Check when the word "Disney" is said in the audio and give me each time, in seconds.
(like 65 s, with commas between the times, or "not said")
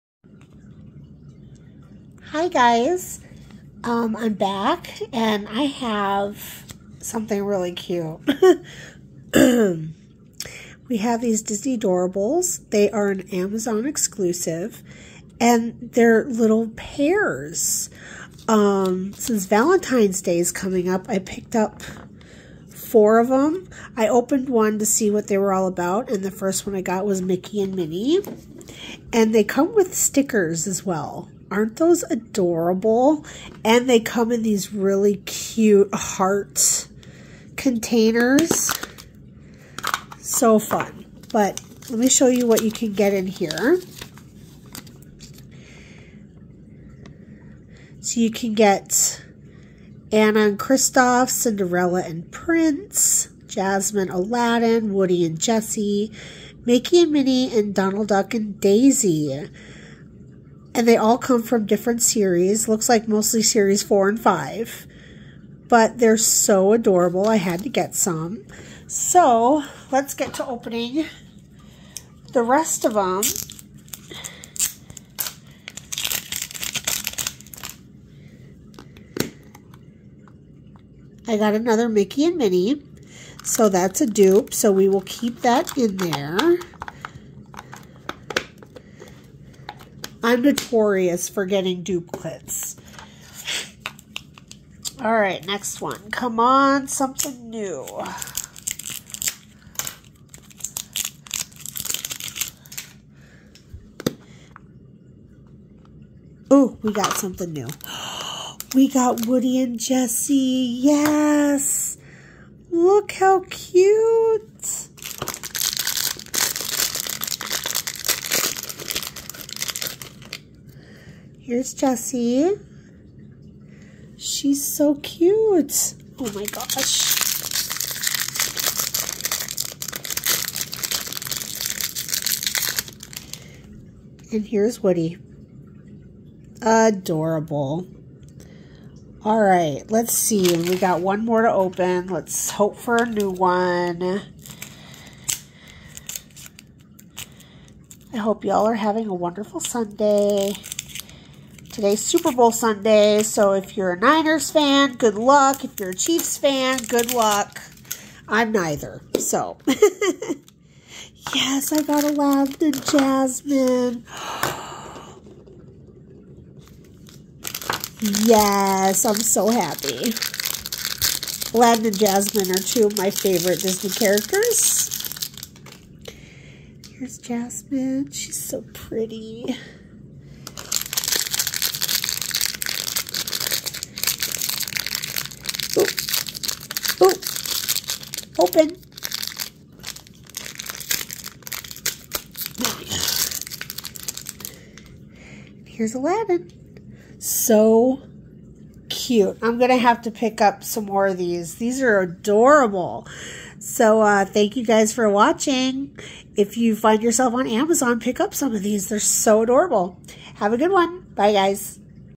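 11 s, 173 s.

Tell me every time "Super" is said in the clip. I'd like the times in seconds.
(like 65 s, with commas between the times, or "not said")
152 s.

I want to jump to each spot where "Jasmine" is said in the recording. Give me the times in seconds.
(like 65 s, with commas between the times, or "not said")
53 s, 162 s, 171 s, 177 s.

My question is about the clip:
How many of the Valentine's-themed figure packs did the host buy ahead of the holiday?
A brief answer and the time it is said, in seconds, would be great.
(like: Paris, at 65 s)
4, at 22 s.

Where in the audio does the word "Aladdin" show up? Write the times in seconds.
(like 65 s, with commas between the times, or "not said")
54 s, 162 s, 171 s, 195 s.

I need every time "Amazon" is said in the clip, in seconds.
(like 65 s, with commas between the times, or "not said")
13 s, 207 s.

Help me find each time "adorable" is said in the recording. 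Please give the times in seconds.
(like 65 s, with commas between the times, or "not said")
32 s, 66 s, 136 s, 202 s, 209 s.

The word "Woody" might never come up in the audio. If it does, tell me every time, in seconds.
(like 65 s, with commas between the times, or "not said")
54 s, 109 s, 134 s.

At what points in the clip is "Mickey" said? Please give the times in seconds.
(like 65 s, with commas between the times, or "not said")
27 s, 56 s, 81 s.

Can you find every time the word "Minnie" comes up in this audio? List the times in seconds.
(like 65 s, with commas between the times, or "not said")
27 s, 57 s, 82 s.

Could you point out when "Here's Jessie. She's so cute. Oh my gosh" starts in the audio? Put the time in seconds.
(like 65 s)
121 s.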